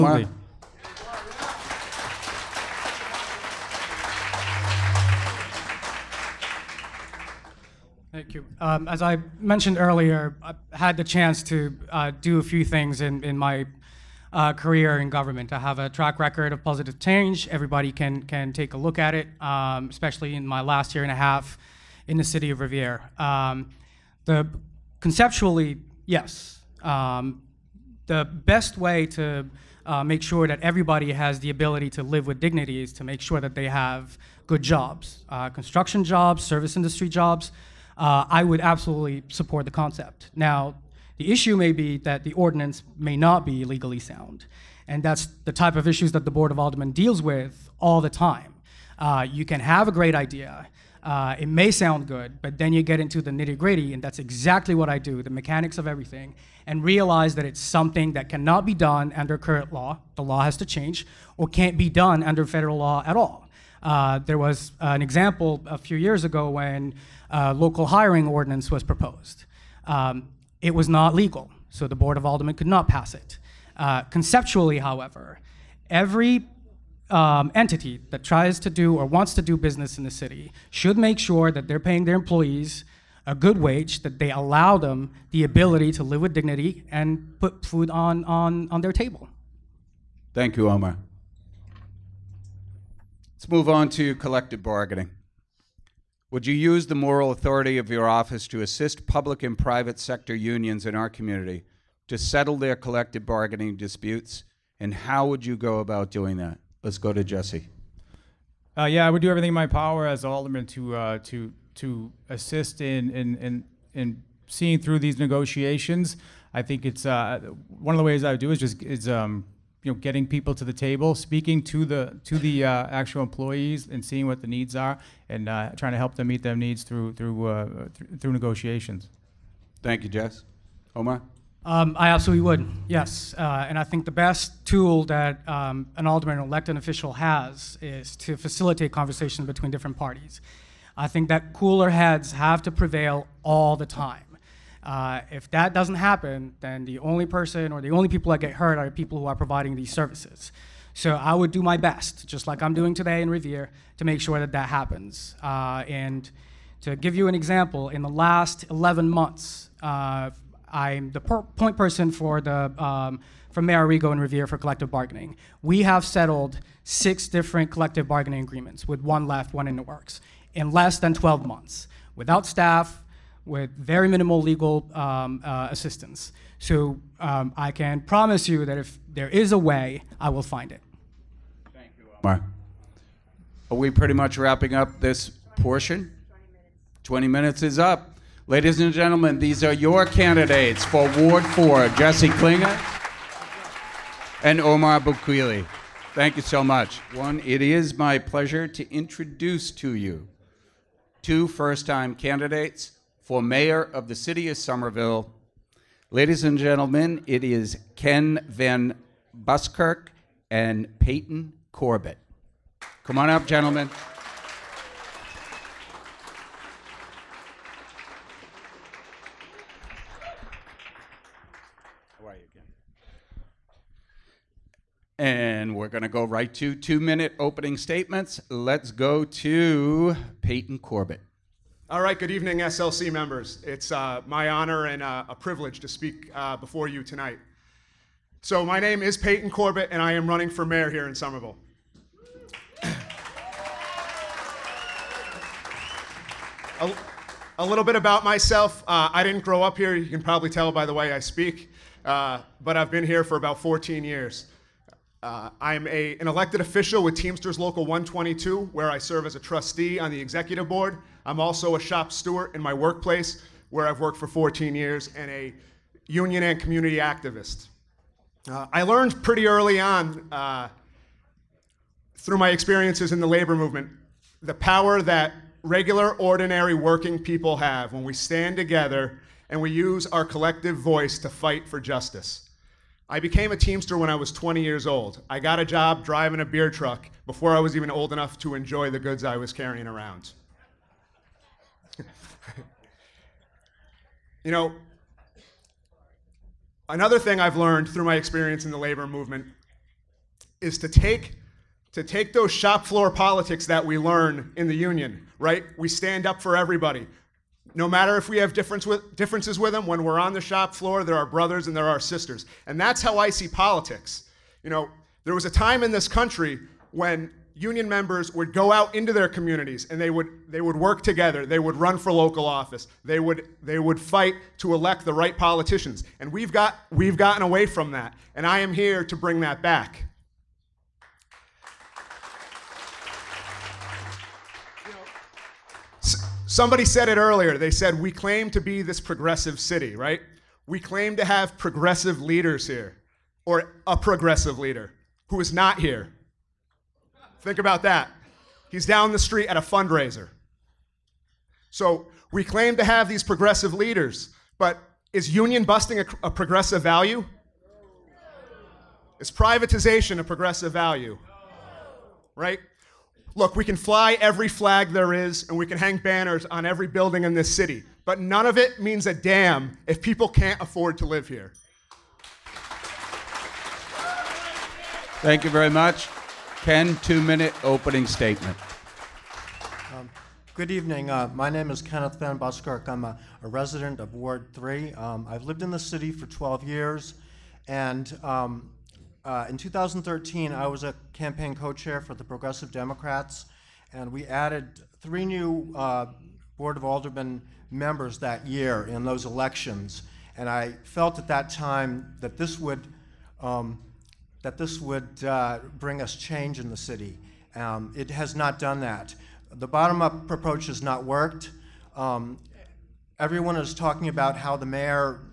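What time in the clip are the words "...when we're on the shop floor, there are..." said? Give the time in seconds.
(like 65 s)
309 s.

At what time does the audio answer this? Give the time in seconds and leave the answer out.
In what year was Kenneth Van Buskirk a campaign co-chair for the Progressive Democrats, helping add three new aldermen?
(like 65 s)
389 s.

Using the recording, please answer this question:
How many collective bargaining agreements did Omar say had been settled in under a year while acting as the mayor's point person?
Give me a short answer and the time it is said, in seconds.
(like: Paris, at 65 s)
6, at 166 s.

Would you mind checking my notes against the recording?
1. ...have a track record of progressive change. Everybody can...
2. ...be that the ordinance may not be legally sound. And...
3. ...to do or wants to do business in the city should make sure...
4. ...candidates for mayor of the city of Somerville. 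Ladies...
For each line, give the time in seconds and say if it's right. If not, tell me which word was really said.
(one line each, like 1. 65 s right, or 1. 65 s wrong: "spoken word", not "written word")
1. 15 s wrong: "positive", not "progressive"
2. 41 s right
3. 78 s right
4. 202 s right.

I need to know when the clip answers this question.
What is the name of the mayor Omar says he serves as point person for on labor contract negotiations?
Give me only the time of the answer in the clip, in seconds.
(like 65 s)
163 s.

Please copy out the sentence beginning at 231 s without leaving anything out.
All right, good evening, SLC members.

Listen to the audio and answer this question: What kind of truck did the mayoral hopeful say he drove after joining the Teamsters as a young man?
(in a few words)
Beer truck.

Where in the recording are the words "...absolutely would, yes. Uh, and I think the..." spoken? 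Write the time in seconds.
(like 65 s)
132 s.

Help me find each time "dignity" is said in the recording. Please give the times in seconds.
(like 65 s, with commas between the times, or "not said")
32 s, 86 s.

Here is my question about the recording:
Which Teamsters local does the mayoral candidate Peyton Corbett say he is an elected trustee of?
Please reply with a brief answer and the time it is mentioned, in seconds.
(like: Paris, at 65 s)
Local 122, at 257 s.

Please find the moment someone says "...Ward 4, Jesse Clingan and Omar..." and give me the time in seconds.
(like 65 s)
191 s.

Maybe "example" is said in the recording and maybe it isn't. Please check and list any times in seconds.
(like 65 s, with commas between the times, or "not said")
65 s, 157 s.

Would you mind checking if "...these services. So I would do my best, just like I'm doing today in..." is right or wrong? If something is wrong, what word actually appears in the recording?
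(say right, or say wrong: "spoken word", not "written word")
right.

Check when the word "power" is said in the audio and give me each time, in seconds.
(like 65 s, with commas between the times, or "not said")
109 s, 274 s.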